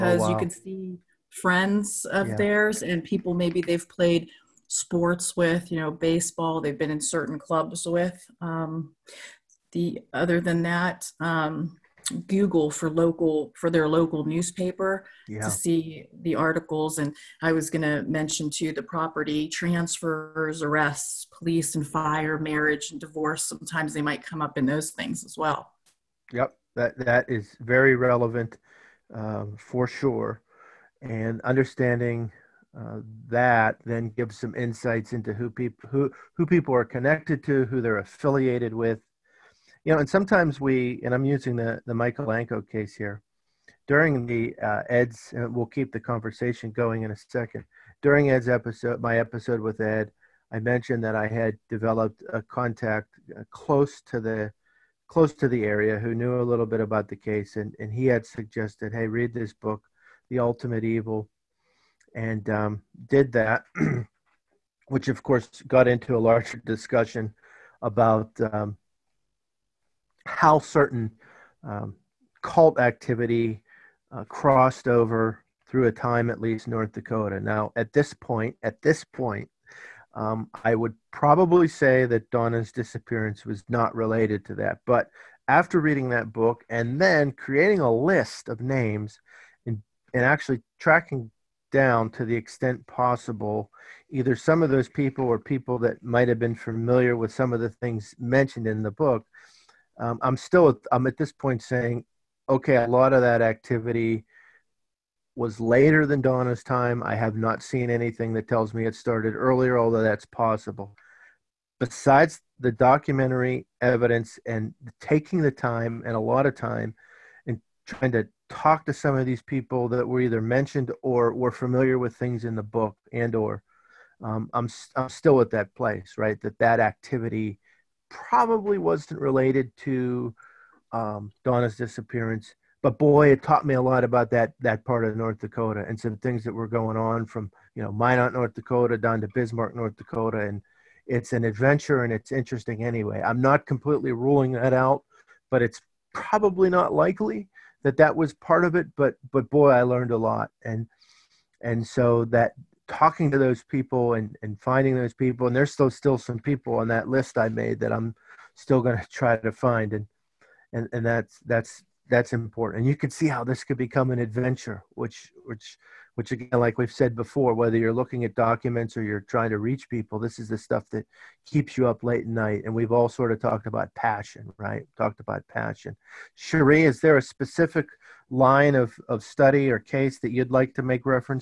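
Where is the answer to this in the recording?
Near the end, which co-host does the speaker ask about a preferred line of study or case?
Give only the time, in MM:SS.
02:56.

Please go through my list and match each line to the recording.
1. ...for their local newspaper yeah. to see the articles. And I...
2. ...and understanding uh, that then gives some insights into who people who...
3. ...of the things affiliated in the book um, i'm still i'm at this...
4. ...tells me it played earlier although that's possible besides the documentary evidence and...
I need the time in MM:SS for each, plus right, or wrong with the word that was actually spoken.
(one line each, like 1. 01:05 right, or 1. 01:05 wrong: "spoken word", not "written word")
1. 00:13 right
2. 00:31 right
3. 01:37 wrong: "mentioned", not "affiliated"
4. 01:48 wrong: "started", not "played".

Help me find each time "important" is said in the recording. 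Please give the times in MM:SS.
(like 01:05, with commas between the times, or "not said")
02:42.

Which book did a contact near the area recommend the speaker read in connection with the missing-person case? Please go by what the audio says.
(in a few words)
The Ultimate Evil.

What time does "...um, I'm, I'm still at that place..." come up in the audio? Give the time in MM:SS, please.
02:04.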